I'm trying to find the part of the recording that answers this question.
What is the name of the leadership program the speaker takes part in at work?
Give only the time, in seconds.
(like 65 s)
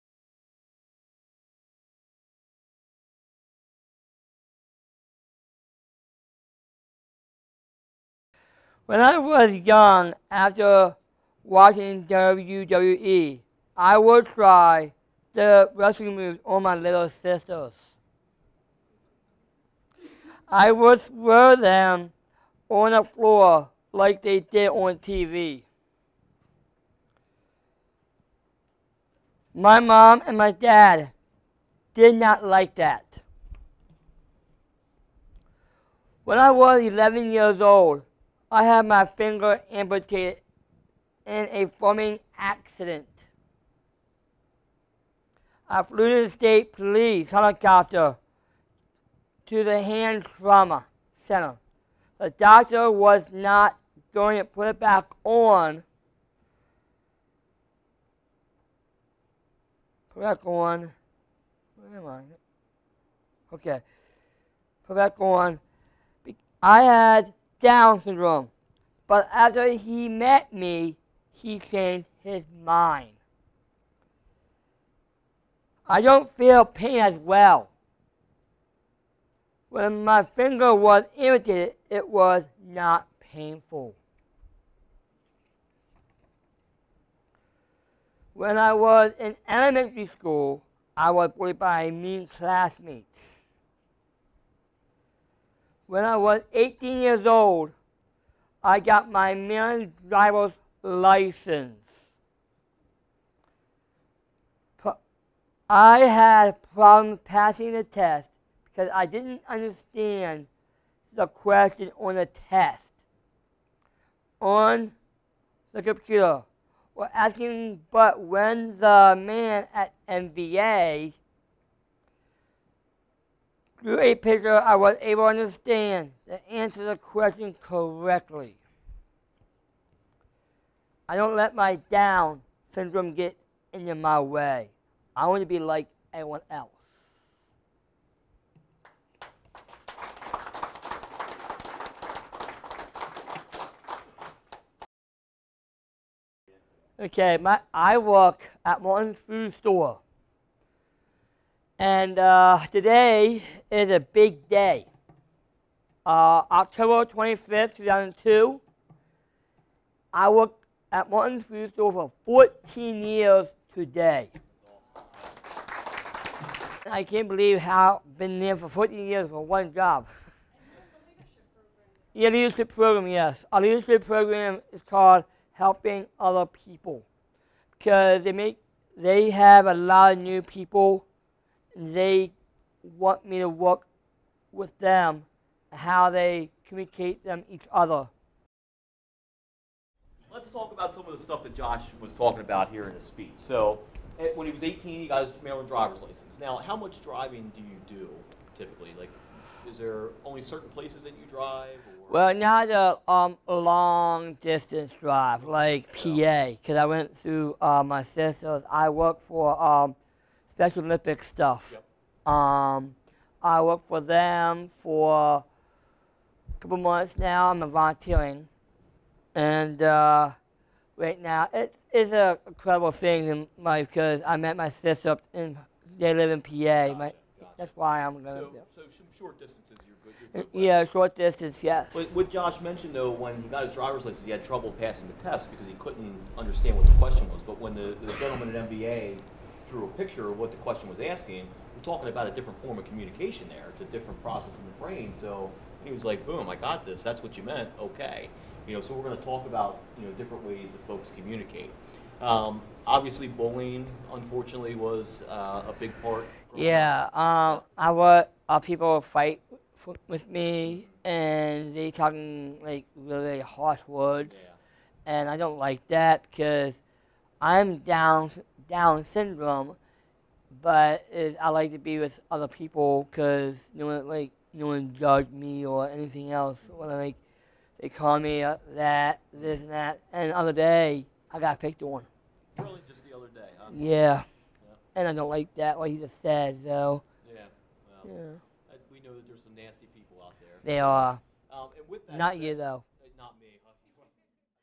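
175 s.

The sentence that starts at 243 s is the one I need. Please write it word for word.
It's a different process in the brain.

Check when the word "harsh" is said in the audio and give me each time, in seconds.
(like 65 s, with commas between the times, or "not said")
263 s.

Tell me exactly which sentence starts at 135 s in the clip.
I want to be like anyone else.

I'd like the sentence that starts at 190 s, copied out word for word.
Let's talk about some of the stuff that Josh was talking about here in his speech.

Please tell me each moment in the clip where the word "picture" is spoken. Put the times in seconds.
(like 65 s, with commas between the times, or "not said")
124 s, 239 s.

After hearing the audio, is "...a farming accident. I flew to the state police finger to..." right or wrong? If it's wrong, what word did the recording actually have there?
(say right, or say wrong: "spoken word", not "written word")
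wrong: "helicopter", not "finger".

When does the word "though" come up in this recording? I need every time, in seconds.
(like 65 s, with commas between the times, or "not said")
232 s, 292 s.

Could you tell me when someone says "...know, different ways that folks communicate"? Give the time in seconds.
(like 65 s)
250 s.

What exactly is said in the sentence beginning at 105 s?
I had problems passing the test because I didn't understand the question on the test on the computer.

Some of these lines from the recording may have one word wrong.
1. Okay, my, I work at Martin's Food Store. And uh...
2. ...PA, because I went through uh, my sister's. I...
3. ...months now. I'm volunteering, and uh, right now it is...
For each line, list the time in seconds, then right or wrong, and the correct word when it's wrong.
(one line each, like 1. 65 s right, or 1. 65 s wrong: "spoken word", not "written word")
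1. 146 s right
2. 205 s right
3. 216 s right.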